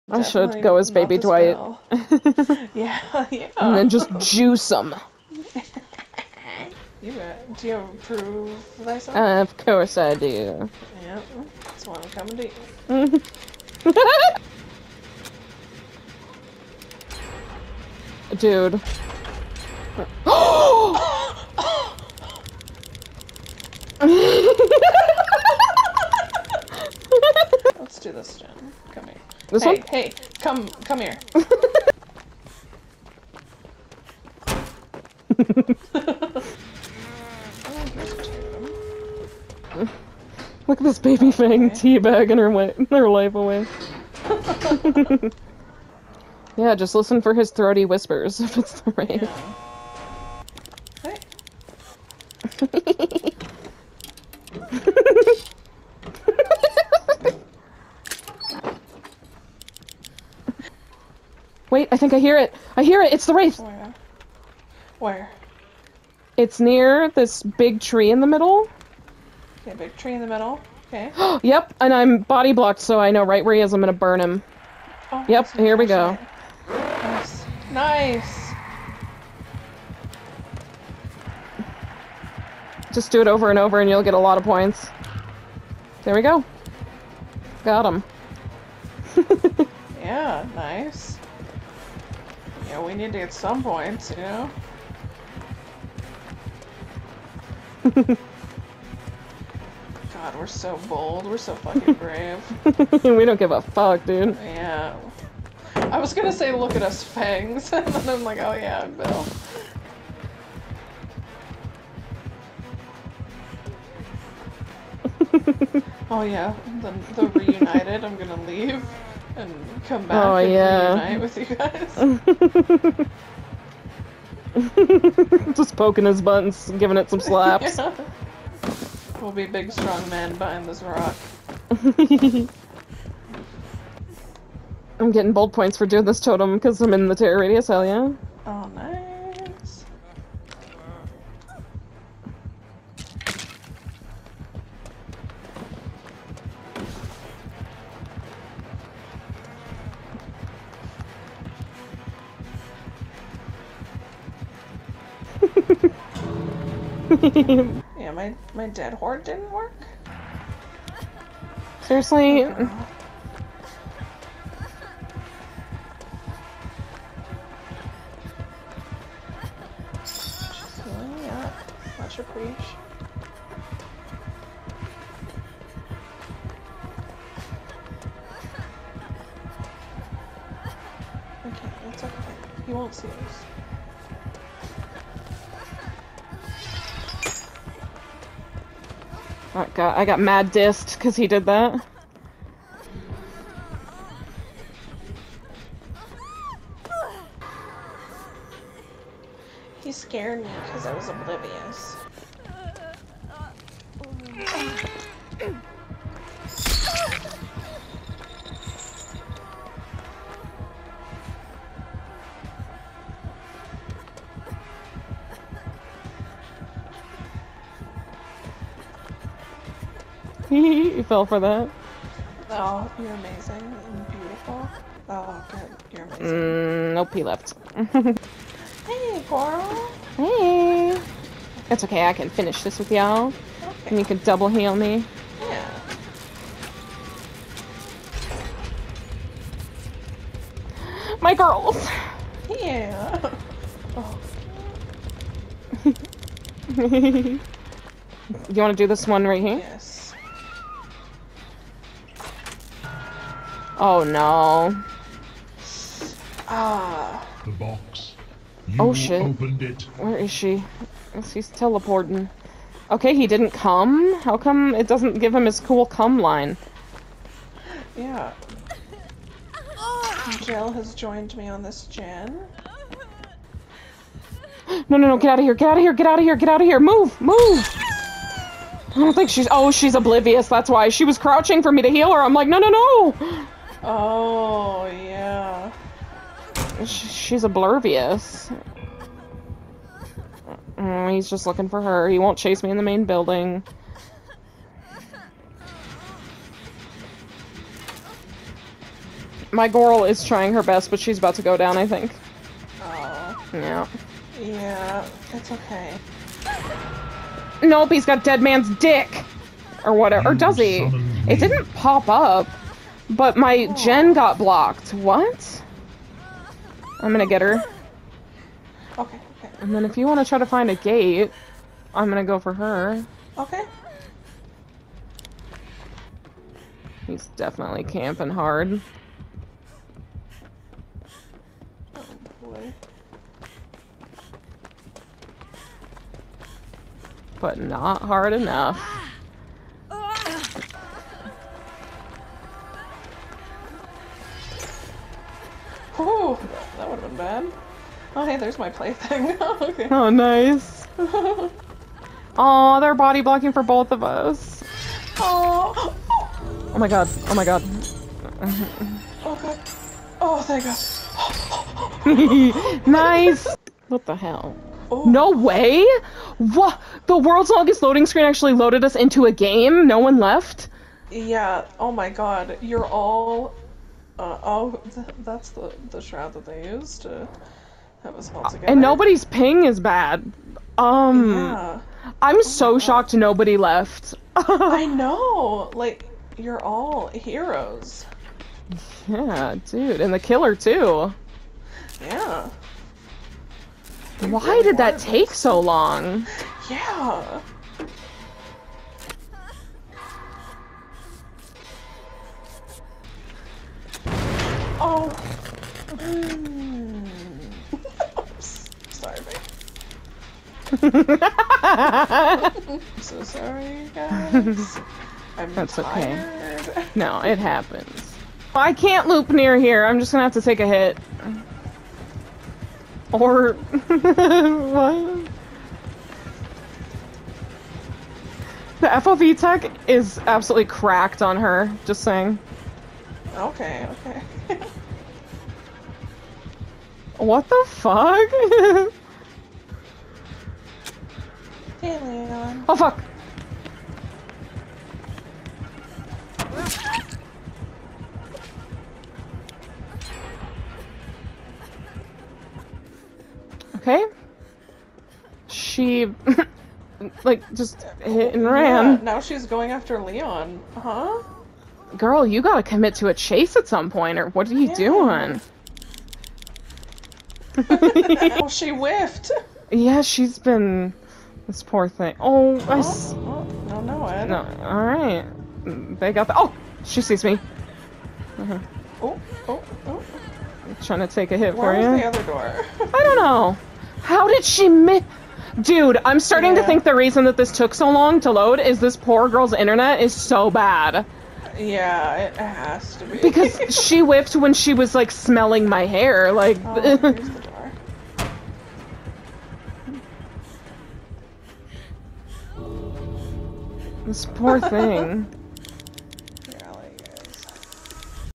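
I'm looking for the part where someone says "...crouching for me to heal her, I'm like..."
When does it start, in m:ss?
4:41.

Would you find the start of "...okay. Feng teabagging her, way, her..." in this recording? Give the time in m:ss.
0:41.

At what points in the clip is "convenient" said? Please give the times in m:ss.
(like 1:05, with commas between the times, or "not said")
not said.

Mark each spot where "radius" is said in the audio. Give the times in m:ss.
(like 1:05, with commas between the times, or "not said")
2:17.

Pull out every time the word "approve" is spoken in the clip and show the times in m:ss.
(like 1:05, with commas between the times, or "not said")
0:07.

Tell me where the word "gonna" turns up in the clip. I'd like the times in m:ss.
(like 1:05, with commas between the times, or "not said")
1:13, 1:46, 1:58, 5:17, 5:22, 7:00.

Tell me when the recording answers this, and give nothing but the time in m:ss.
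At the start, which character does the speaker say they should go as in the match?
0:00.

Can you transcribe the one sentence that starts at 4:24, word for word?
How come it doesn't give him his cool come line?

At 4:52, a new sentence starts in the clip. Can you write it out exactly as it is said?
He won't chase me in the main building.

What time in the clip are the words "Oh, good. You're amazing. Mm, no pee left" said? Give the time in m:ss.
3:45.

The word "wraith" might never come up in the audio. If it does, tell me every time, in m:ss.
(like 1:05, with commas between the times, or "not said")
0:48, 1:03.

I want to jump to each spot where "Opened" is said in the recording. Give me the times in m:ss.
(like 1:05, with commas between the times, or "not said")
4:19.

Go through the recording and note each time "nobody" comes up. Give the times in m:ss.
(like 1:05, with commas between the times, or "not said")
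6:18, 6:23.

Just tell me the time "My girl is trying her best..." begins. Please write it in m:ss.
4:59.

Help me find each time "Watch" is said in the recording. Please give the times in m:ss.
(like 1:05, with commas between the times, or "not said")
2:51.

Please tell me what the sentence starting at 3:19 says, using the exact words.
He scared me because I was oblivious.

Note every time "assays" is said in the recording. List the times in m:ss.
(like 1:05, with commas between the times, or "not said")
not said.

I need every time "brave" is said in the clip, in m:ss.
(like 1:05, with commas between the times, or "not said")
1:41.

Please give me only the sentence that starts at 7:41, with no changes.
Girl, you gotta commit to a chase at some point, or what are you yeah.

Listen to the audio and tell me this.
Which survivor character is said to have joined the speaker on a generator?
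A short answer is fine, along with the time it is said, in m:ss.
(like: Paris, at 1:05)
Jill, at 4:30.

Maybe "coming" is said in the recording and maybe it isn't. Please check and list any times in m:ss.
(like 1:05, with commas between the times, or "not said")
0:12.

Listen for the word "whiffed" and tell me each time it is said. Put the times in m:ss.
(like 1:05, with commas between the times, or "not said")
7:48.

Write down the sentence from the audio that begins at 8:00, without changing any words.
I'm trying to take a hit Where for you.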